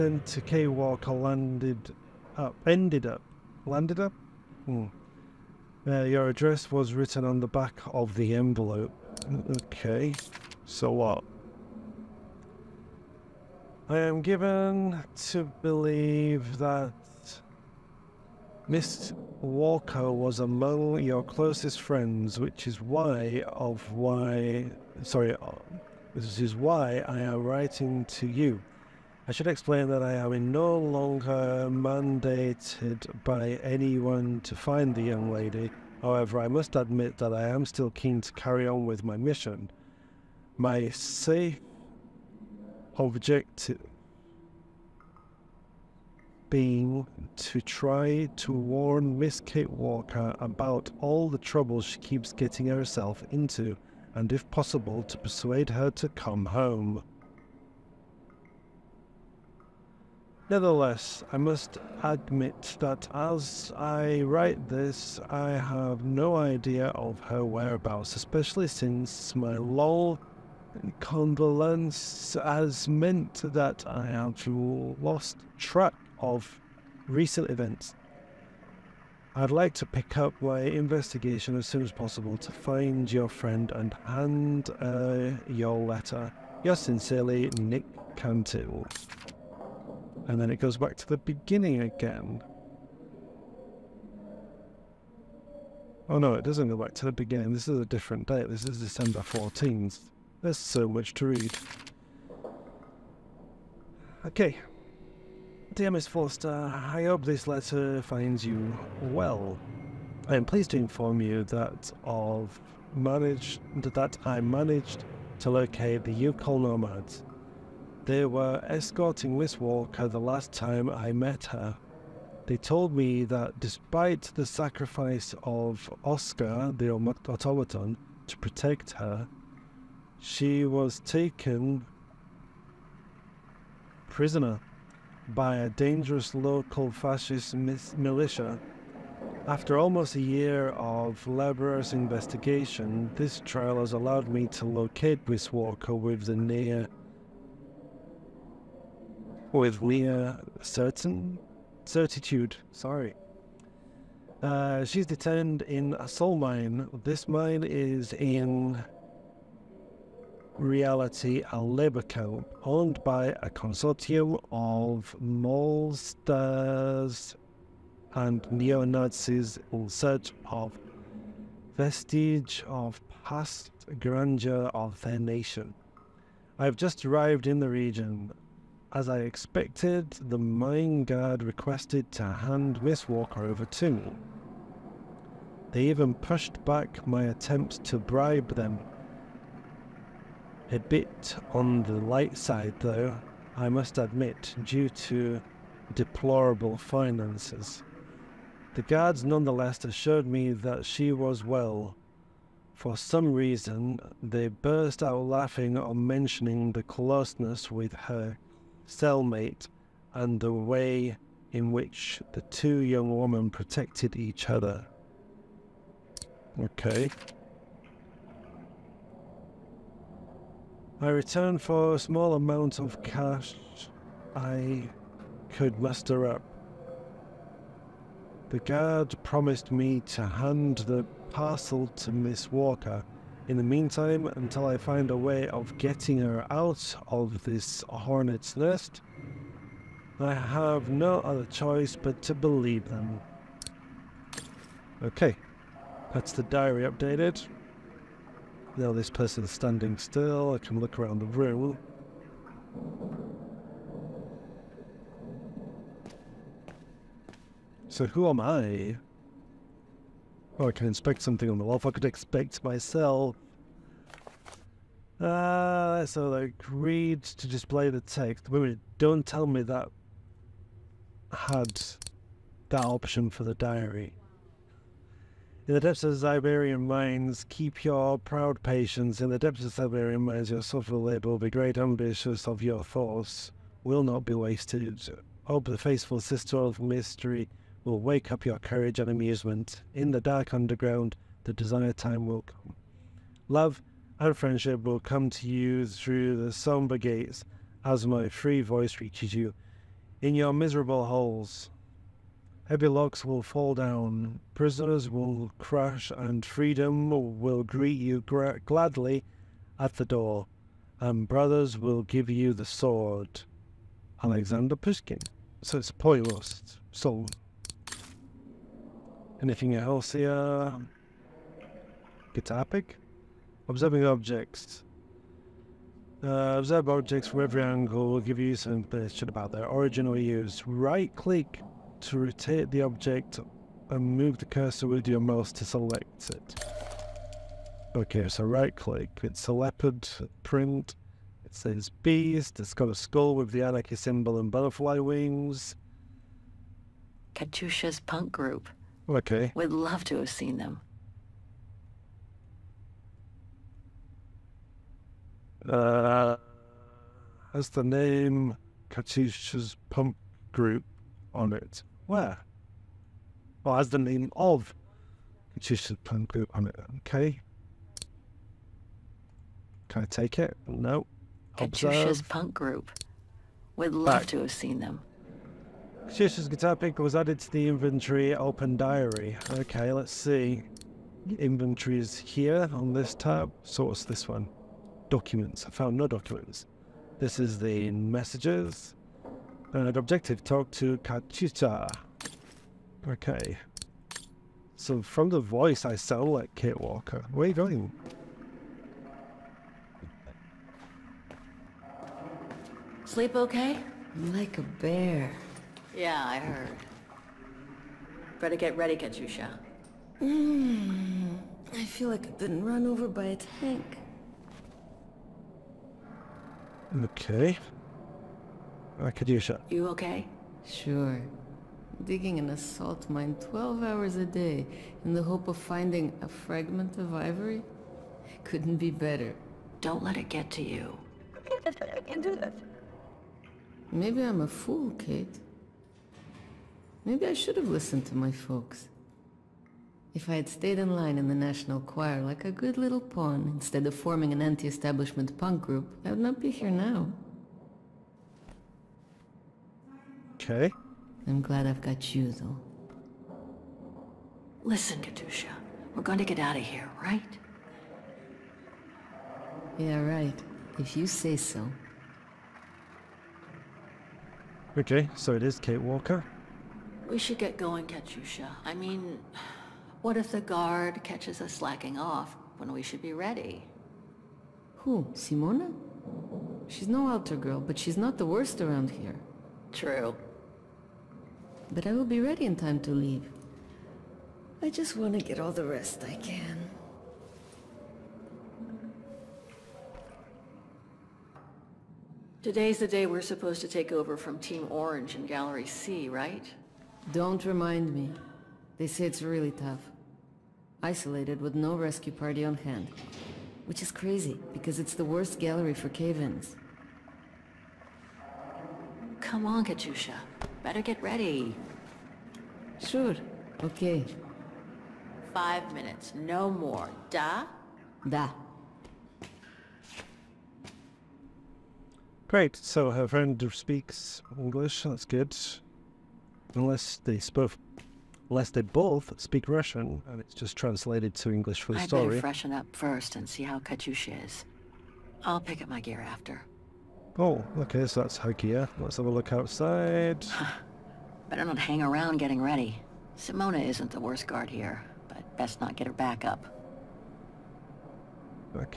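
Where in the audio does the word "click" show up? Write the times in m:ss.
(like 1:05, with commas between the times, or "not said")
5:31, 5:38.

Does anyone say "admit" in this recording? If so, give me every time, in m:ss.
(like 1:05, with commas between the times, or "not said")
0:36, 1:02, 3:13.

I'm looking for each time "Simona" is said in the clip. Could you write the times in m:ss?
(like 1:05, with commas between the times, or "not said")
7:55, 9:03.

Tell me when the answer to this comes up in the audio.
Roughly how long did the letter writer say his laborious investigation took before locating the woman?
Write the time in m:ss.
2:19.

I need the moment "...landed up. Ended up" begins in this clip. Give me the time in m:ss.
0:01.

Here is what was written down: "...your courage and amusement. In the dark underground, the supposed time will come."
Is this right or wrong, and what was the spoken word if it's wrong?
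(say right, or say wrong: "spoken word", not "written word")
wrong: "desired", not "supposed".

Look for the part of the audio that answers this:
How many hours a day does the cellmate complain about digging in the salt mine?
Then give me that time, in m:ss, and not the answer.
7:03.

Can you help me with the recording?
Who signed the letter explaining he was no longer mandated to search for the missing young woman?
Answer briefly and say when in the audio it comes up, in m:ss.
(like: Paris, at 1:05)
Nick Cantil, at 1:27.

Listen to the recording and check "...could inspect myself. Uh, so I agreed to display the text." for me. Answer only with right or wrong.
right.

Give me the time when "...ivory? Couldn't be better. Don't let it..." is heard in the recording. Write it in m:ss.
7:07.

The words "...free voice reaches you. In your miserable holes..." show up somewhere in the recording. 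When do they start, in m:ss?
4:58.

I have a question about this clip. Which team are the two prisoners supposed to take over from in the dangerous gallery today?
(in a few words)
Team Orange.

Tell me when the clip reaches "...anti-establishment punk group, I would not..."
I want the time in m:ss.
7:24.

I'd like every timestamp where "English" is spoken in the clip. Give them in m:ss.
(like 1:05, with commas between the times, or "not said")
8:44, 8:51.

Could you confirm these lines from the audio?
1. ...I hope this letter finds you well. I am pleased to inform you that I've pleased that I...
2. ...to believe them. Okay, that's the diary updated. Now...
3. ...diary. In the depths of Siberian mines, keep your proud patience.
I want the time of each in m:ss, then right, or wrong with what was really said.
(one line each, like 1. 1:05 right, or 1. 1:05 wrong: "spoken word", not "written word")
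1. 1:46 wrong: "managed", not "pleased"
2. 4:02 right
3. 4:33 right.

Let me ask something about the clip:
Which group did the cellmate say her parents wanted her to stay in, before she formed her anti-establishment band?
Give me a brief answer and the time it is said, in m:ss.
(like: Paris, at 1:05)
National Choir, at 7:21.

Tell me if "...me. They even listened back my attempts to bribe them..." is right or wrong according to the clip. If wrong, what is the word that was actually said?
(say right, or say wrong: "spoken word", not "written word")
wrong: "pushed", not "listened".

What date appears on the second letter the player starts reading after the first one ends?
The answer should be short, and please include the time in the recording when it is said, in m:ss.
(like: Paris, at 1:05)
December 14th, at 1:38.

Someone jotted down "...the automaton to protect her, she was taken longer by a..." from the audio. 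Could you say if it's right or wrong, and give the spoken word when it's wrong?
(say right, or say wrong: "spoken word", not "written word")
wrong: "prisoner", not "longer".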